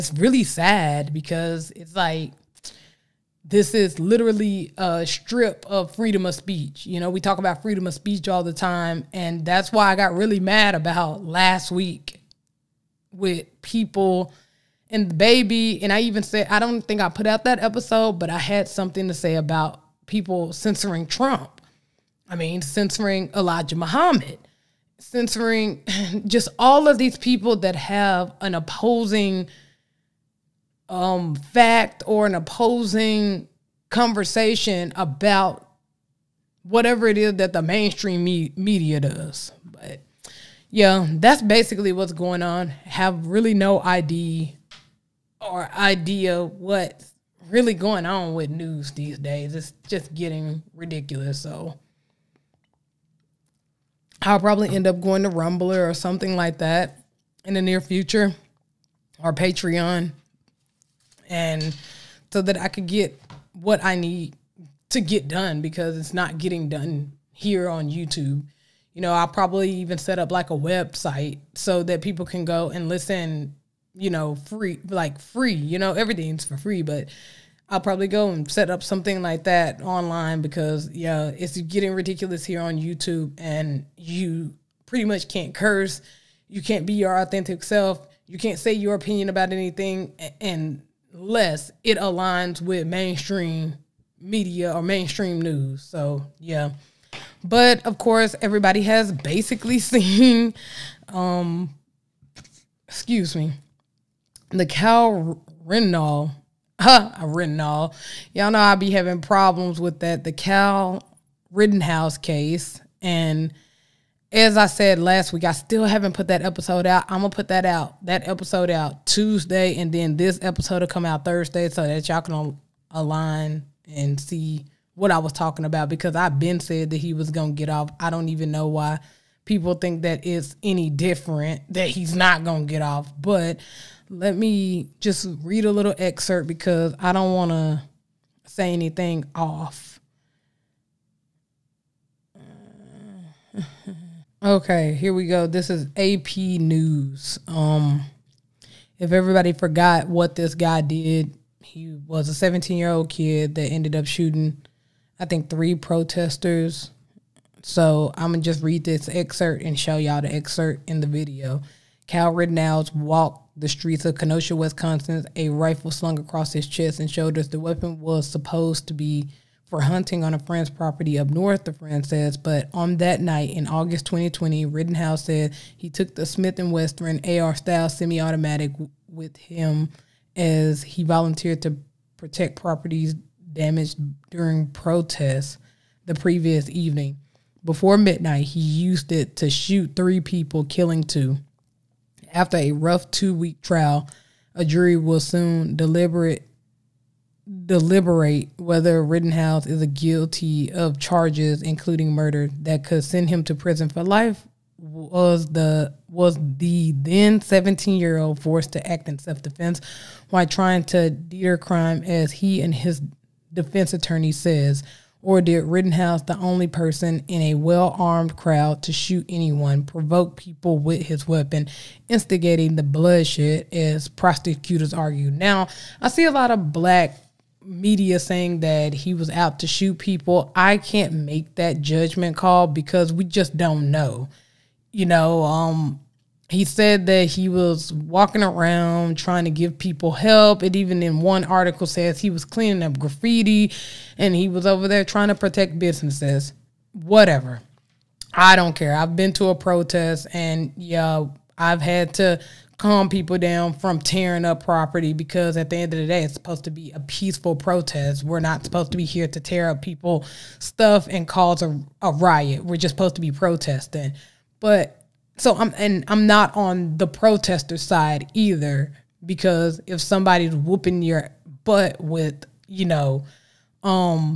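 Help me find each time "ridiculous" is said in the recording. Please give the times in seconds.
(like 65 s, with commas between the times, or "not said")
50 s, 81 s.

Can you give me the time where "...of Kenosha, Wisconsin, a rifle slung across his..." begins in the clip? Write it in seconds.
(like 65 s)
164 s.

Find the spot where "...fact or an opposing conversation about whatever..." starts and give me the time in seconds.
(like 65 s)
31 s.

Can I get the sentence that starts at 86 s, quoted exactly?
You can't be your authentic self.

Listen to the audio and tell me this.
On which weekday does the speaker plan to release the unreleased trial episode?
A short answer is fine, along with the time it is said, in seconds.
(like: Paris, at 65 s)
Tuesday, at 119 s.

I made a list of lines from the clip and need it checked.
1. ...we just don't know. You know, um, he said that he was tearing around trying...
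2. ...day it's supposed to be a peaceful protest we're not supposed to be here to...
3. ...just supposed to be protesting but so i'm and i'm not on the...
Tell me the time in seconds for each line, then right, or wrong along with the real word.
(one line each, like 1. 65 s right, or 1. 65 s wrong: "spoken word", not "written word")
1. 233 s wrong: "walking", not "tearing"
2. 256 s right
3. 262 s right.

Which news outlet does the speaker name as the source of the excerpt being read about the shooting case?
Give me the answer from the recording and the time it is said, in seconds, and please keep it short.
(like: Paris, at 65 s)
AP News, at 145 s.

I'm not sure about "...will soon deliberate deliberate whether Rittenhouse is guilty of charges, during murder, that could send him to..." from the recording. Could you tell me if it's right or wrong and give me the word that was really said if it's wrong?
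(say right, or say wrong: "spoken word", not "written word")
wrong: "including", not "during".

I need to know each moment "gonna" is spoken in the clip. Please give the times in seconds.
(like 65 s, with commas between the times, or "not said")
117 s, 127 s, 132 s, 158 s.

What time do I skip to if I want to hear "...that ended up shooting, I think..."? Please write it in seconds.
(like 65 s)
153 s.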